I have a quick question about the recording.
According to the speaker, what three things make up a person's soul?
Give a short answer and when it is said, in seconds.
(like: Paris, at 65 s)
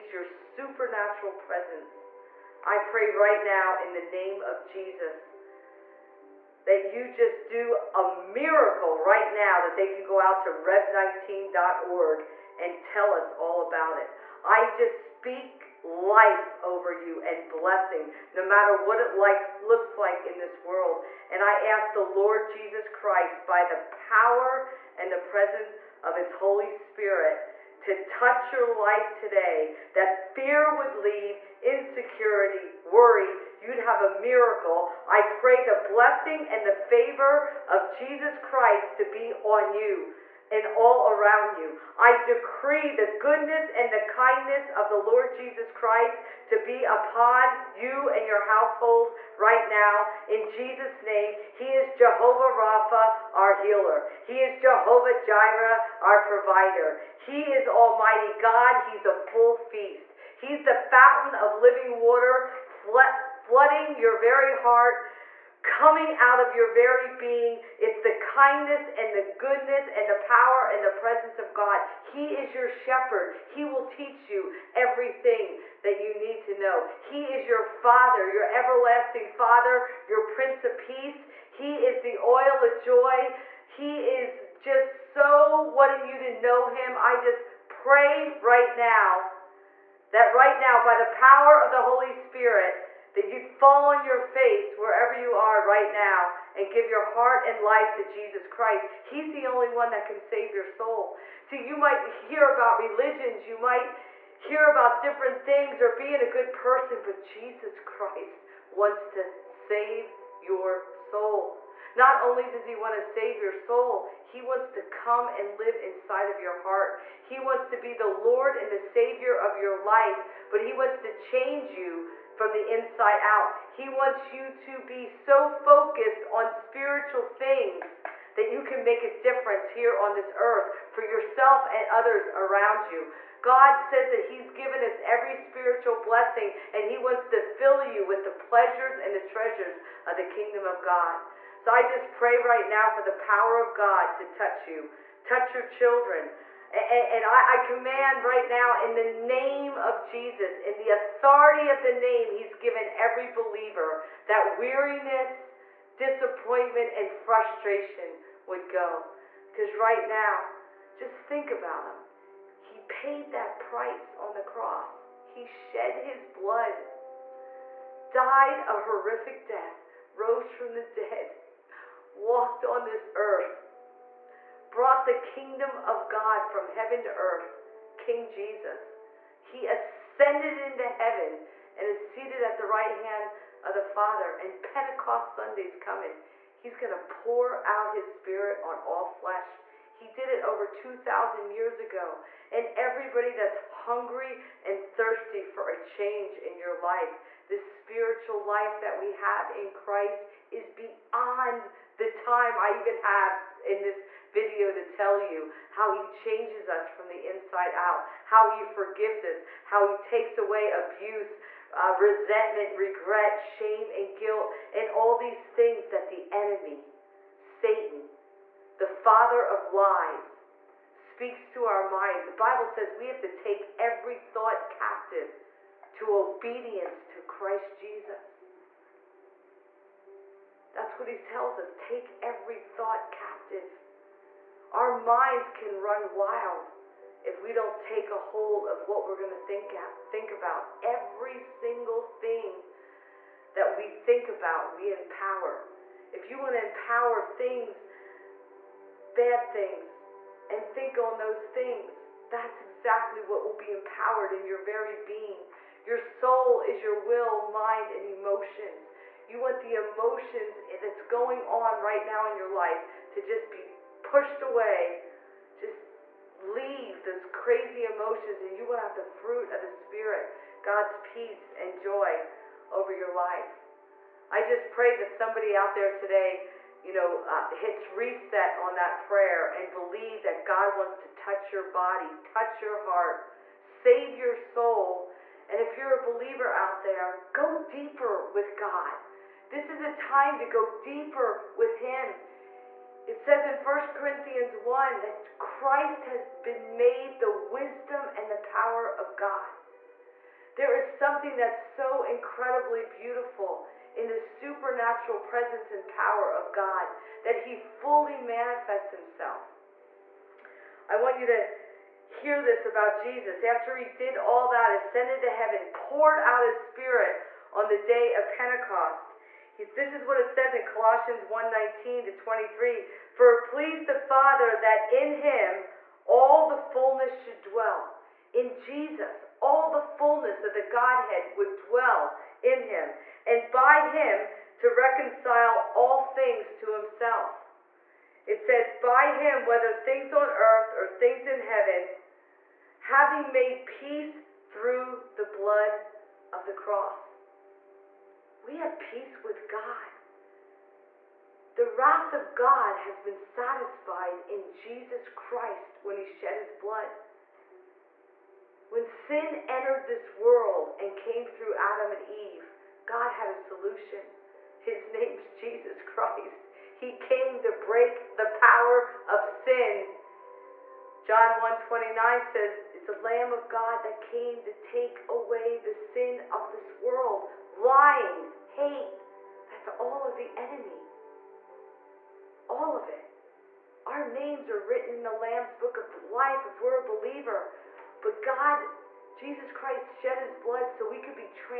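will, mind, and emotions, at 257 s.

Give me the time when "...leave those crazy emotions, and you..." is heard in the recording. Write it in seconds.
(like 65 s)
266 s.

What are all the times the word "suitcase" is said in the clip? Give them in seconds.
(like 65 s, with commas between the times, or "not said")
not said.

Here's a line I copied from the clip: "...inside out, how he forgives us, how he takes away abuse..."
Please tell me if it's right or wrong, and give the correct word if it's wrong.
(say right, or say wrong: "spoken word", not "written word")
right.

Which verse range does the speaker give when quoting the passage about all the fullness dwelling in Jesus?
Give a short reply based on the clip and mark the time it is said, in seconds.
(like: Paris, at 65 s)
Colossians 19 to 23, at 320 s.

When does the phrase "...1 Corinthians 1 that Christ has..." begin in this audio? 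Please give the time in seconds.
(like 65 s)
293 s.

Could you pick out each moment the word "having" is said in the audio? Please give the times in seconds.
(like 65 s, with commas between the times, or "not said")
342 s.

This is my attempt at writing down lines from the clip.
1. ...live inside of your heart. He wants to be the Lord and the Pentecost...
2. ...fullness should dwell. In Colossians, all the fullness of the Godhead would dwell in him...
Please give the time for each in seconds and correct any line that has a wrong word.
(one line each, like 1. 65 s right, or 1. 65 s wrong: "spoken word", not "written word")
1. 115 s wrong: "Savior", not "Pentecost"
2. 326 s wrong: "Jesus", not "Colossians".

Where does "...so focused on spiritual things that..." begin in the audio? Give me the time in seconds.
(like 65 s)
125 s.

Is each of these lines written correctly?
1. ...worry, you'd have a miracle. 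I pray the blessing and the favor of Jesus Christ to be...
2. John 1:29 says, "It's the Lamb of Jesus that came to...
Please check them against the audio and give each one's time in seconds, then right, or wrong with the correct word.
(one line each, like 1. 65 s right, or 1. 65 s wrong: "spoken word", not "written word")
1. 32 s right
2. 371 s wrong: "God", not "Jesus".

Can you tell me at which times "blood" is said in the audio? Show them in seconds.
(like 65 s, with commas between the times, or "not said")
166 s, 345 s, 356 s, 390 s.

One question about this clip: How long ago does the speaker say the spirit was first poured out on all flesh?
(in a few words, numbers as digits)
over 2,000 years.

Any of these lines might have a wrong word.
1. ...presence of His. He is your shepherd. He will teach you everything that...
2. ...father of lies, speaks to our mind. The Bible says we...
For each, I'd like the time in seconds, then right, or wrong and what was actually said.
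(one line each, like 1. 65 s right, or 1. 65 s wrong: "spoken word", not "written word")
1. 70 s wrong: "God", not "His"
2. 218 s right.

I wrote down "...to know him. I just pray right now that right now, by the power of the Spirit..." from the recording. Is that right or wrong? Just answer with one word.
wrong.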